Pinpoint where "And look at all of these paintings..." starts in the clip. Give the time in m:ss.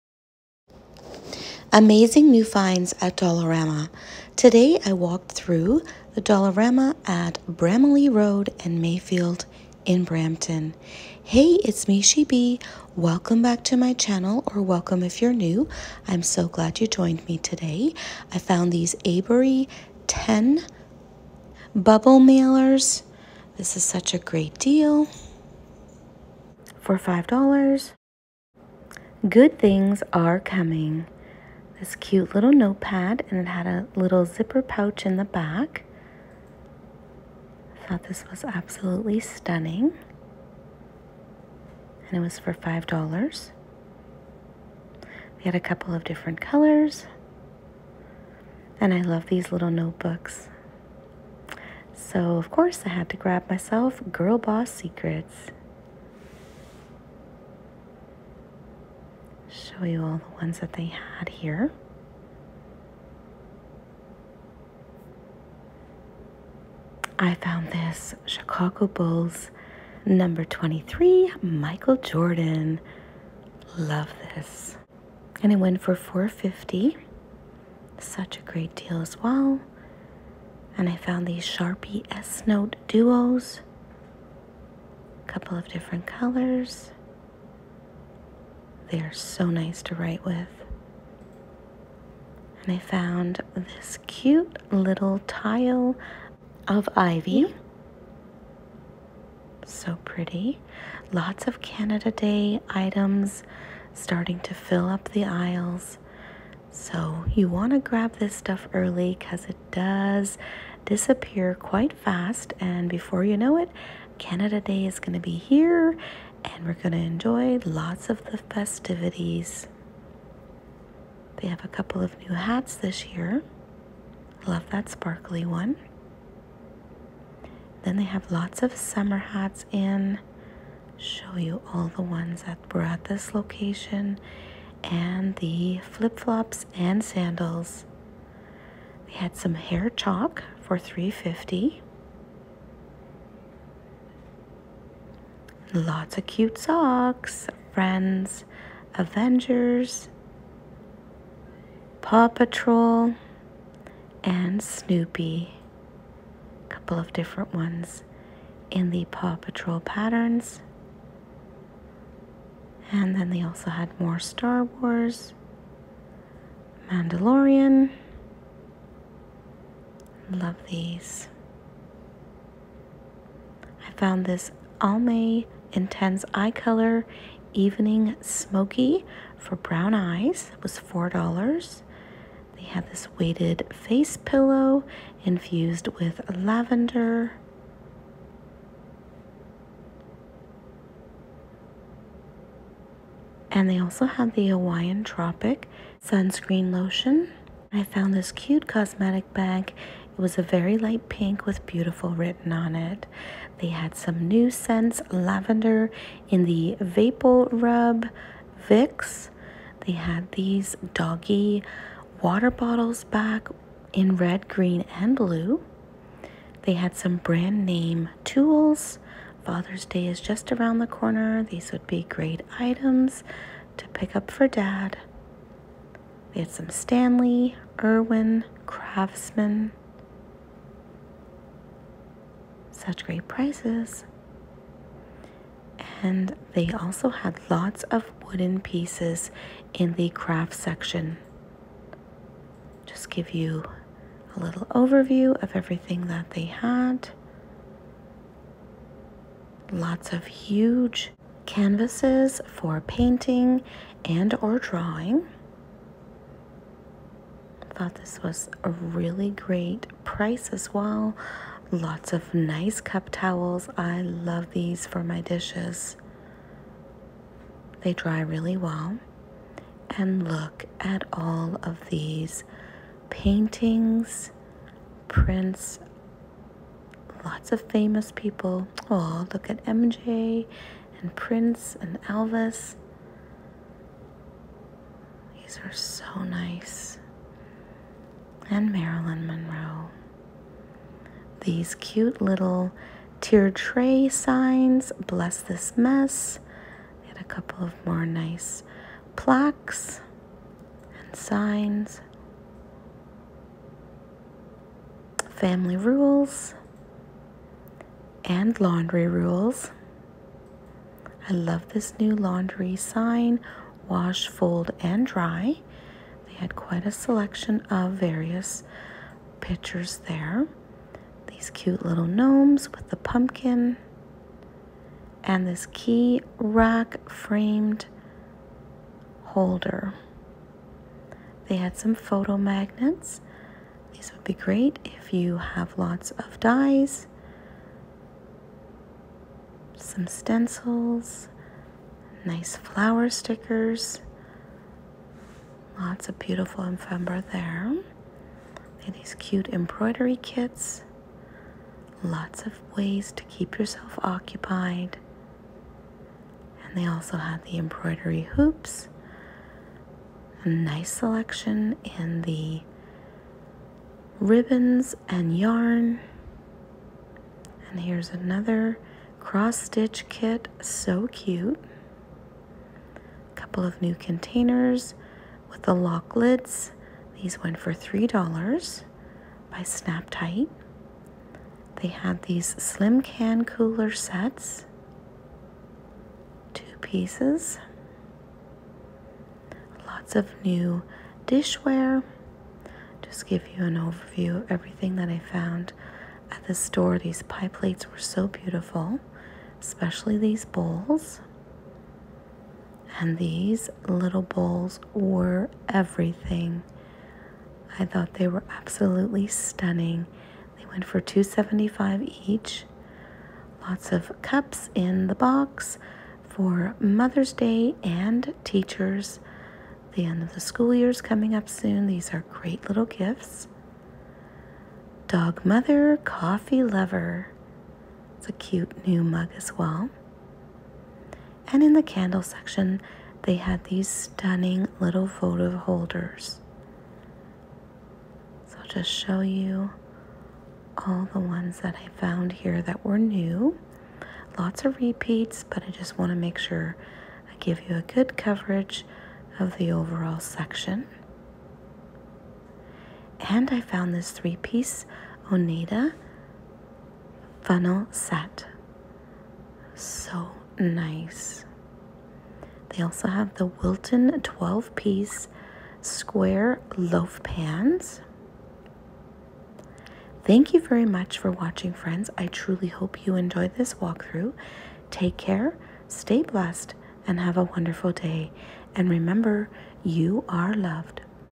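4:29.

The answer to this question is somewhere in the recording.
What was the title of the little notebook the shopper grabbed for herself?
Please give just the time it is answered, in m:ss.
0:54.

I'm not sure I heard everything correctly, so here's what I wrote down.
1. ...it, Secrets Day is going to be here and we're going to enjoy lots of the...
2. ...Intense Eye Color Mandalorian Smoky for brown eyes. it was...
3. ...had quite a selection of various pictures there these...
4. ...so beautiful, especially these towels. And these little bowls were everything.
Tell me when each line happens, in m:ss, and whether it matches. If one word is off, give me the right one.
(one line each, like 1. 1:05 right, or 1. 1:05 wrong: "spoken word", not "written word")
1. 1:53 wrong: "Canada", not "Secrets"
2. 2:55 wrong: "Evening", not "Mandalorian"
3. 5:16 right
4. 6:37 wrong: "bowls", not "towels".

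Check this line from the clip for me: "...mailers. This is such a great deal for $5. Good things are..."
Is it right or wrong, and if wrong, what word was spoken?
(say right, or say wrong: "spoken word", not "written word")
right.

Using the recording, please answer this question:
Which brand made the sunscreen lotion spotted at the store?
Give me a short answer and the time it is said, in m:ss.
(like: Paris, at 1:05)
Hawaiian Tropic, at 3:14.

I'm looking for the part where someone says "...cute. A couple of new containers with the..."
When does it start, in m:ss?
6:11.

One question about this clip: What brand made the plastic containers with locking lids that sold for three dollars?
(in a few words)
Snap Tight.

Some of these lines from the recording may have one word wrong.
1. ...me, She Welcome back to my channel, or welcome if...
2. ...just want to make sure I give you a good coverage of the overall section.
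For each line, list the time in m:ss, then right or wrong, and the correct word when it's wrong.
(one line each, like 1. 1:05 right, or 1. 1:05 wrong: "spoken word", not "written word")
1. 0:11 right
2. 7:25 right.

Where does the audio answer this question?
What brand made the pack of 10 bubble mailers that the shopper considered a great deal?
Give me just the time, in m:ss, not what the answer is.
0:19.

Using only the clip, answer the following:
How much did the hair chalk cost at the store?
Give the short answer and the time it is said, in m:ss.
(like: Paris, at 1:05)
$3.50, at 2:20.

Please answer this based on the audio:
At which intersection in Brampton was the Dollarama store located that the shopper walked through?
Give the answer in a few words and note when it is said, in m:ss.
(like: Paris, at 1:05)
Bramalea Road and Mayfield, at 0:07.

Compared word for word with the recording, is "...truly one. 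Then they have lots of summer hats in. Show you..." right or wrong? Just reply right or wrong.
wrong.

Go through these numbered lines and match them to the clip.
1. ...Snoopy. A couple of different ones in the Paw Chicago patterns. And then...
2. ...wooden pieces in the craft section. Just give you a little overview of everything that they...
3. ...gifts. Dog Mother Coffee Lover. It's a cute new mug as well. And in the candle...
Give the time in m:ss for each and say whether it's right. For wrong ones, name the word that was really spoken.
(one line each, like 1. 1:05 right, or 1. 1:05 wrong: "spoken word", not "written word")
1. 2:34 wrong: "Patrol", not "Chicago"
2. 3:58 right
3. 7:02 right.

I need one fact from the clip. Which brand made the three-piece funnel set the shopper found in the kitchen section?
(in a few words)
Oneida.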